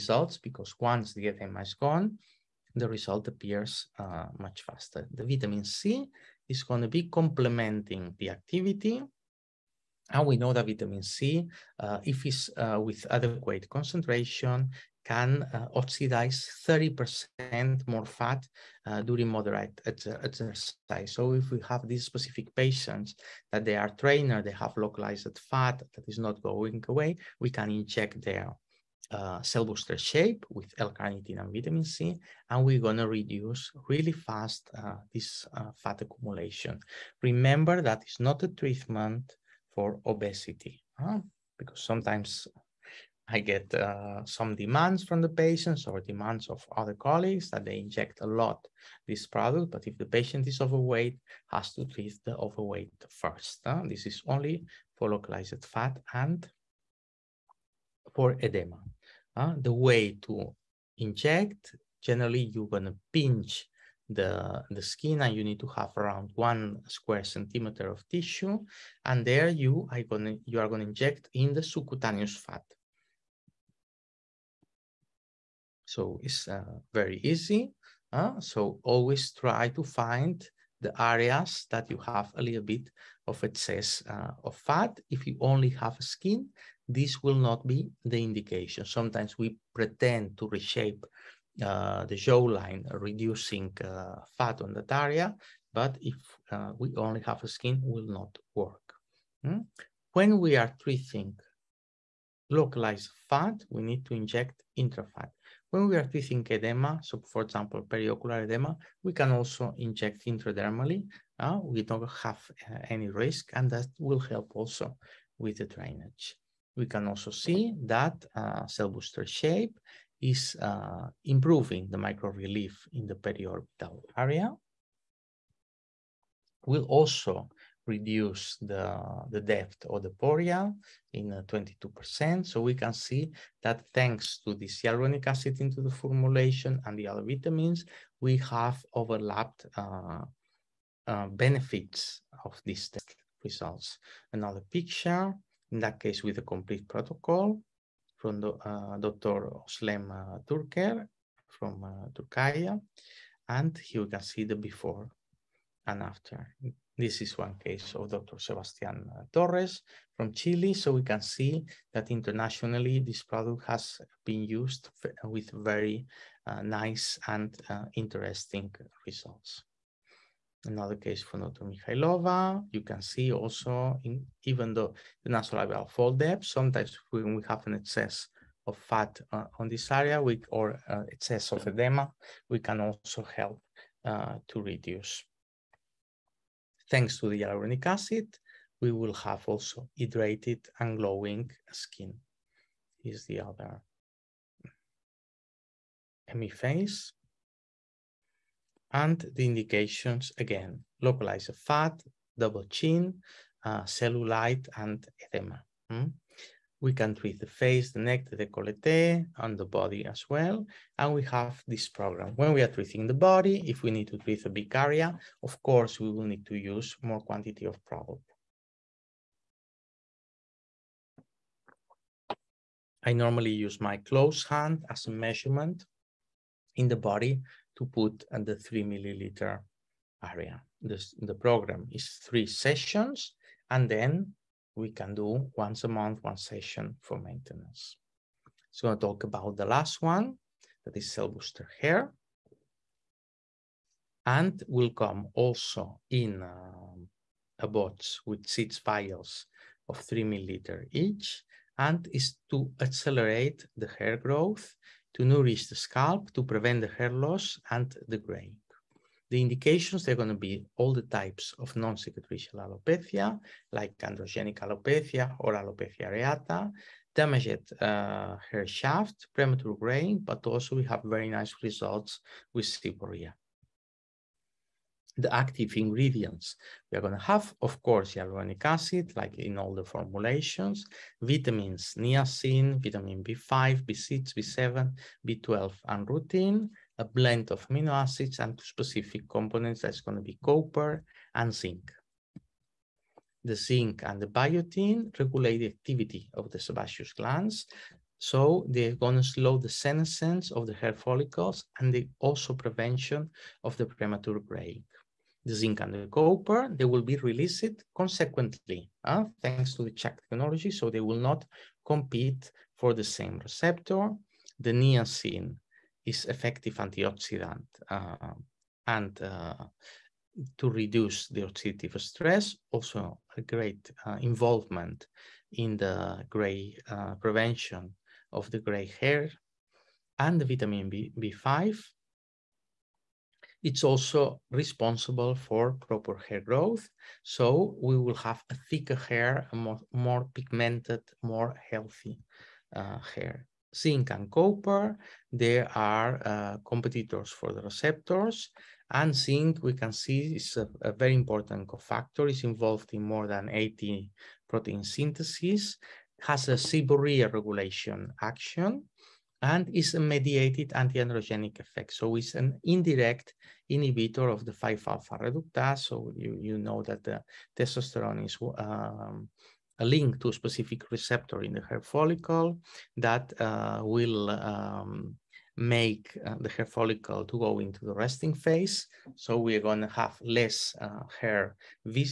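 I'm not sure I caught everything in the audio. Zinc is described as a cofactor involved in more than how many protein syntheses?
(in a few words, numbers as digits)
80.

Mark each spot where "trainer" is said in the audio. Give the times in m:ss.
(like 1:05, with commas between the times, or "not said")
0:24.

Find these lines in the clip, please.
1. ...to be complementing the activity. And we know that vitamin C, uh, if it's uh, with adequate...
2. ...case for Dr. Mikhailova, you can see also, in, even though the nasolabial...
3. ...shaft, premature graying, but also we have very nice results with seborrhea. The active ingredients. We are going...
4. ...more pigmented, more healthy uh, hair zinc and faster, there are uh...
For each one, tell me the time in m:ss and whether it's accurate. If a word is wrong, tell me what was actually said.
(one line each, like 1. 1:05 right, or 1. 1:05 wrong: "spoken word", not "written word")
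1. 0:06 right
2. 2:50 right
3. 4:28 right
4. 5:39 wrong: "copper", not "faster".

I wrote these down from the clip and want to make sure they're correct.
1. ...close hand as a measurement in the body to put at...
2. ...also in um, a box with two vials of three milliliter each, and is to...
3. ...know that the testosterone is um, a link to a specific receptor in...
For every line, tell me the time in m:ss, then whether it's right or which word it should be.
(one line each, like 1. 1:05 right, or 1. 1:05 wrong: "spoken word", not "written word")
1. 3:43 right
2. 4:05 wrong: "six", not "two"
3. 6:06 right.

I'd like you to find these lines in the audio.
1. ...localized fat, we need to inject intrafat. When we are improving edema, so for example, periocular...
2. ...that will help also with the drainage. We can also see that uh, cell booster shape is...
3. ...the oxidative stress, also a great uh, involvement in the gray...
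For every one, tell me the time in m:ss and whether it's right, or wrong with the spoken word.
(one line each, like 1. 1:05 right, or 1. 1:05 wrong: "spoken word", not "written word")
1. 1:42 wrong: "treating", not "improving"
2. 1:53 right
3. 5:21 right.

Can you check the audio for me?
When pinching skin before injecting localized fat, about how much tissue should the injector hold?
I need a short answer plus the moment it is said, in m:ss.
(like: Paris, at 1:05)
1 square centimeter, at 1:06.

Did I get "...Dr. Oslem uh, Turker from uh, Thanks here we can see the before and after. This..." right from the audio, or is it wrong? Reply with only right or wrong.
wrong.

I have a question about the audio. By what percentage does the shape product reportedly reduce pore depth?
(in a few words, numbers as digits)
22%.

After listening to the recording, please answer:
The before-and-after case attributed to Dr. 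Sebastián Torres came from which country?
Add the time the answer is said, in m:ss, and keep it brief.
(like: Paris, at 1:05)
Chile, at 2:40.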